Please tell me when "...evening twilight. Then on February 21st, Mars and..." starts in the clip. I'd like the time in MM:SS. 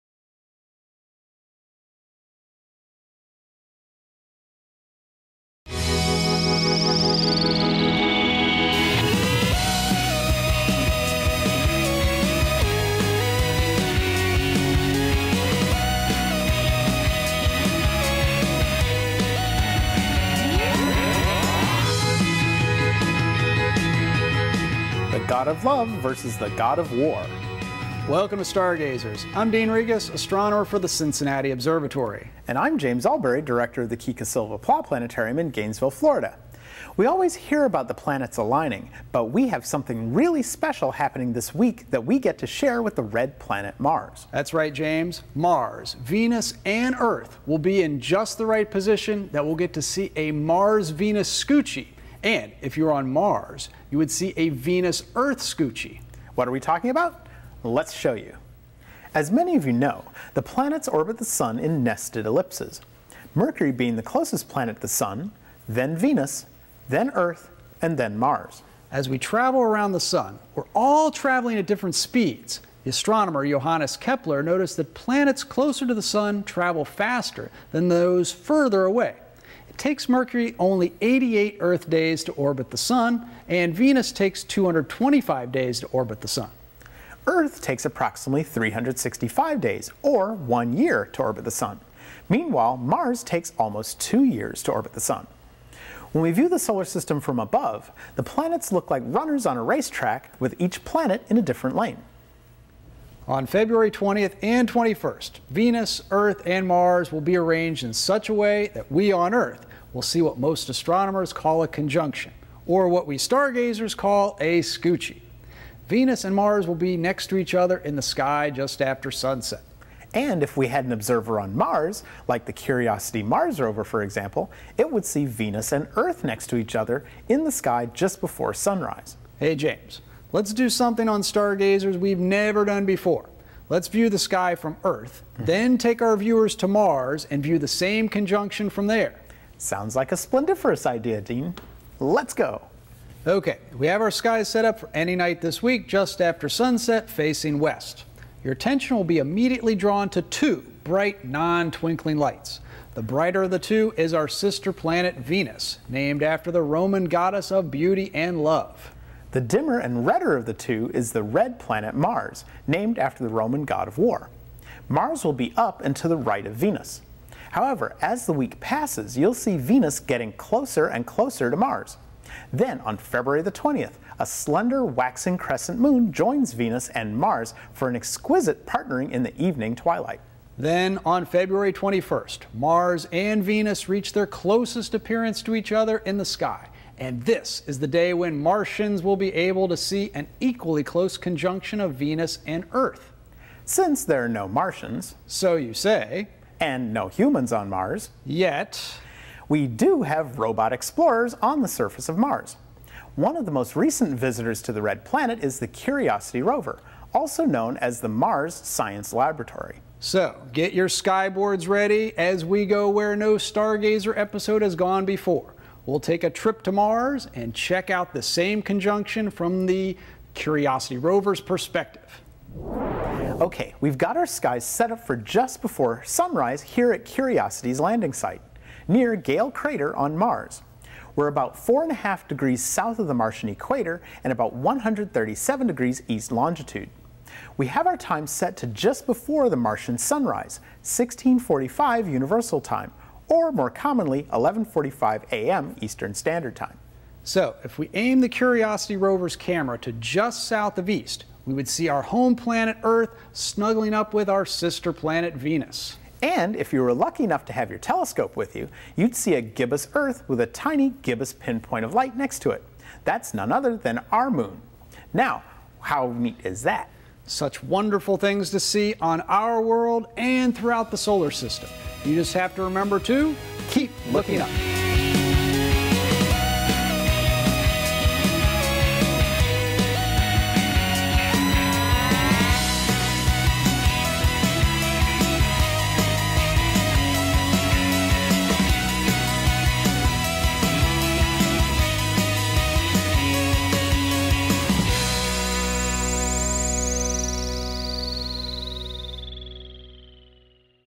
02:59.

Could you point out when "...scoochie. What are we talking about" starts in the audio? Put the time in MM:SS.
00:55.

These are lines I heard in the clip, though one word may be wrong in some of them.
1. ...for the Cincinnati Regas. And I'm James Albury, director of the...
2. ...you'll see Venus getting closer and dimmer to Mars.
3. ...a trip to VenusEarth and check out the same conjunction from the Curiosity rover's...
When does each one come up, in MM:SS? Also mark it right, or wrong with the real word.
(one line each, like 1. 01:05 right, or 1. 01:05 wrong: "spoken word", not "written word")
1. 00:30 wrong: "Observatory", not "Regas"
2. 02:49 wrong: "closer", not "dimmer"
3. 03:36 wrong: "Mars", not "VenusEarth".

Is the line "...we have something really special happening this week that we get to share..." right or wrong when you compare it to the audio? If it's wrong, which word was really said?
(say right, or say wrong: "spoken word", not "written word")
right.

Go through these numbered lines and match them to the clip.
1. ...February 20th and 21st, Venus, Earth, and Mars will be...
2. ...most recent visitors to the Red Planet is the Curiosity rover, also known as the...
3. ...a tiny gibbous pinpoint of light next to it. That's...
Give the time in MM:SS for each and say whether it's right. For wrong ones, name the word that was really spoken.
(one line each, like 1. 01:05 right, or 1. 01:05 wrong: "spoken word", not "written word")
1. 01:43 right
2. 03:23 right
3. 04:20 right.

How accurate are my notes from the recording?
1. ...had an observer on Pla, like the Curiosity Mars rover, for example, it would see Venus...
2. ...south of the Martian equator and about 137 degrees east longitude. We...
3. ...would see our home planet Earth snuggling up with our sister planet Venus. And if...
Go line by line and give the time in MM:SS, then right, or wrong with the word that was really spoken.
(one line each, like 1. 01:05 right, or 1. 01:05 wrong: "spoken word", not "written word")
1. 02:00 wrong: "Mars", not "Pla"
2. 03:52 right
3. 04:11 right.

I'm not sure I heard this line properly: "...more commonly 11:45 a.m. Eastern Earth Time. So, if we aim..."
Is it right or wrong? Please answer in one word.
wrong.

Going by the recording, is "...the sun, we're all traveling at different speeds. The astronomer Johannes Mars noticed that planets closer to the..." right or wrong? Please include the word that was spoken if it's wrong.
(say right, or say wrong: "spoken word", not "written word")
wrong: "Kepler", not "Mars".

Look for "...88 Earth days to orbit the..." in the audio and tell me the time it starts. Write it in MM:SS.
01:20.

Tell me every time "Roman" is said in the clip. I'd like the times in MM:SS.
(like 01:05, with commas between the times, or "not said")
02:36, 02:43.